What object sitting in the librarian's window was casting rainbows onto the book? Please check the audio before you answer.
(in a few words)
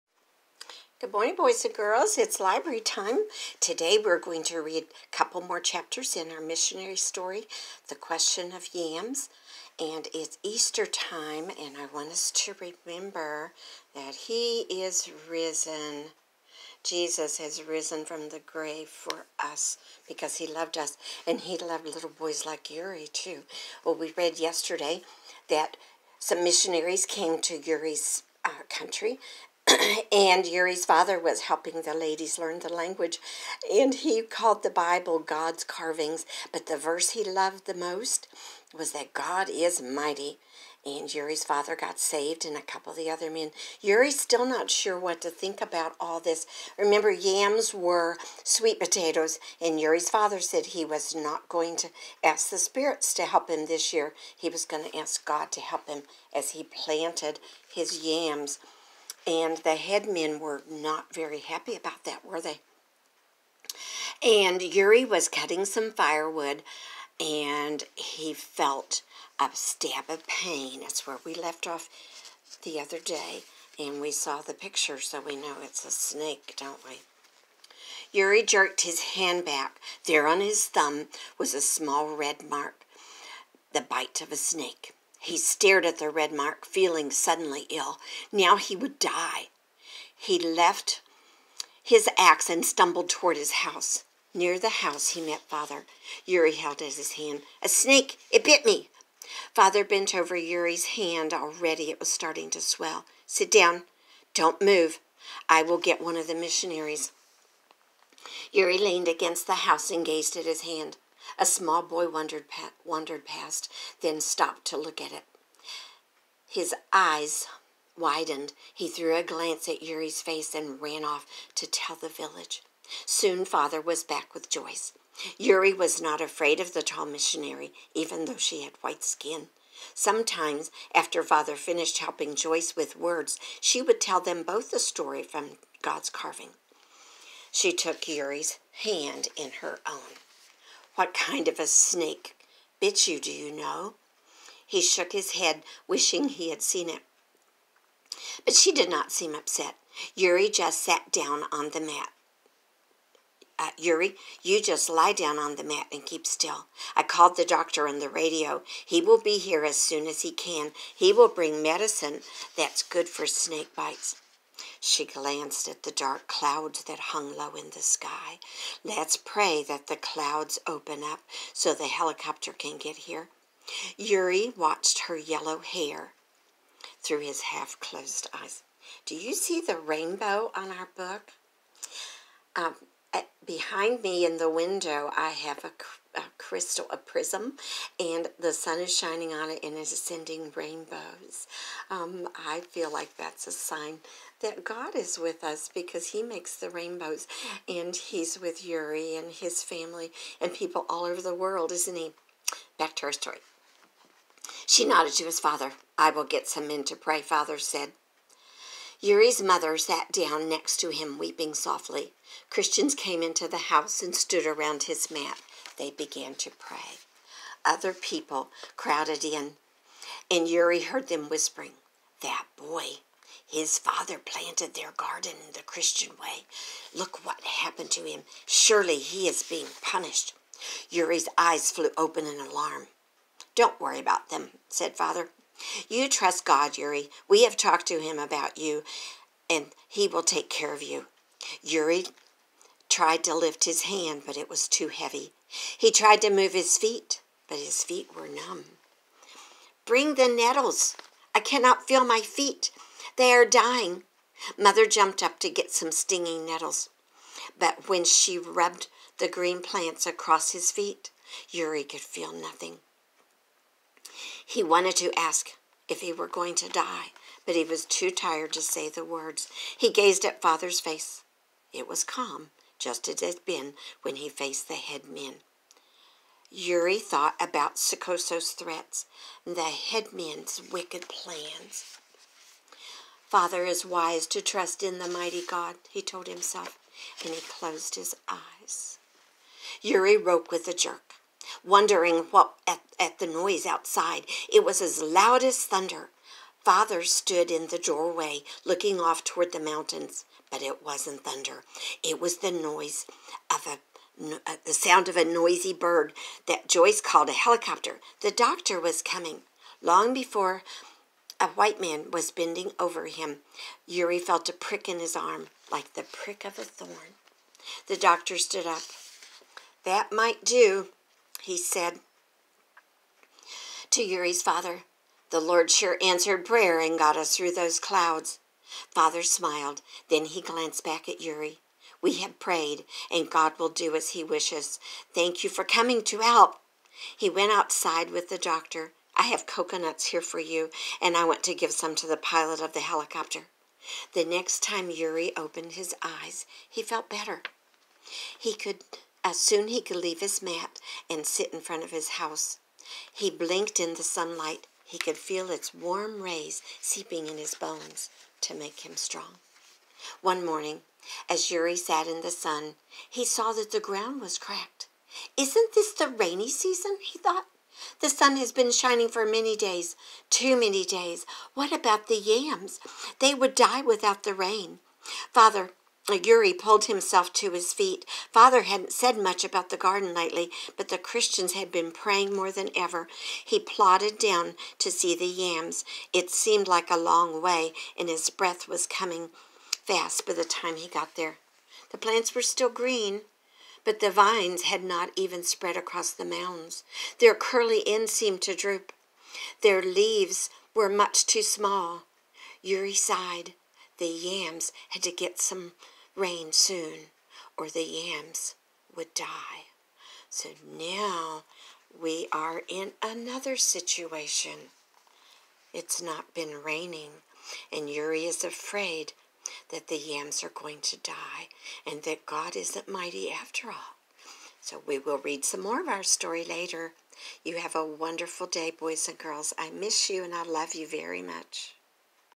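A prism.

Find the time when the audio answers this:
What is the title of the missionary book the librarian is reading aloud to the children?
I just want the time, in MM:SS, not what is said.
00:07.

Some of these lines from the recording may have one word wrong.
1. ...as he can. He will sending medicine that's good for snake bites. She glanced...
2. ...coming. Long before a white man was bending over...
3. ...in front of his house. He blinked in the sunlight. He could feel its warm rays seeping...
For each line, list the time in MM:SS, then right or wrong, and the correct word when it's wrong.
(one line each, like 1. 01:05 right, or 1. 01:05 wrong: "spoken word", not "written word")
1. 02:40 wrong: "bring", not "sending"
2. 05:09 right
3. 05:51 right.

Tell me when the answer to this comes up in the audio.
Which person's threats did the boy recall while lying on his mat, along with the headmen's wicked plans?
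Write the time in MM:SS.
04:37.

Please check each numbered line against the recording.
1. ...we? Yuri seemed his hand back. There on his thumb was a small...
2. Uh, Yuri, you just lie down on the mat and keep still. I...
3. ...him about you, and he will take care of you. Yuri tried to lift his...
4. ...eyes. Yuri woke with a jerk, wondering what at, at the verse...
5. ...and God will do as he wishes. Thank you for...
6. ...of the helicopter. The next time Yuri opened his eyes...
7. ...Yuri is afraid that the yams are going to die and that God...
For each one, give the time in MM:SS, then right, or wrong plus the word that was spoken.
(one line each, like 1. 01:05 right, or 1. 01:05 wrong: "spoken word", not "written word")
1. 01:16 wrong: "jerked", not "seemed"
2. 02:33 right
3. 03:57 right
4. 04:48 wrong: "noise", not "verse"
5. 05:33 right
6. 05:42 right
7. 06:57 right.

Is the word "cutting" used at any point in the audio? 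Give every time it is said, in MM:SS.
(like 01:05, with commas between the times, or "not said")
01:05.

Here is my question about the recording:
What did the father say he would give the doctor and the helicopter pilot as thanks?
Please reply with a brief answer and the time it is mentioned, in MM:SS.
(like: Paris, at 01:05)
Coconuts, at 05:39.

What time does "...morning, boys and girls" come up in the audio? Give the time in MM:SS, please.
00:01.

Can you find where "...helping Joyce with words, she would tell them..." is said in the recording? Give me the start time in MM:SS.
02:11.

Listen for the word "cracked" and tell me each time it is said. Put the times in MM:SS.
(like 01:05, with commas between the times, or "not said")
06:04.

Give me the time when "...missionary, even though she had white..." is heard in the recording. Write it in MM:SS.
02:07.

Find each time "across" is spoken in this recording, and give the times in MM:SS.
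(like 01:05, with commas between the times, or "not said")
04:20, 06:35.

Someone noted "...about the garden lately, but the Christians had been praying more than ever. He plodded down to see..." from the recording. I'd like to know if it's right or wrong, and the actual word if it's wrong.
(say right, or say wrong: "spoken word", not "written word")
right.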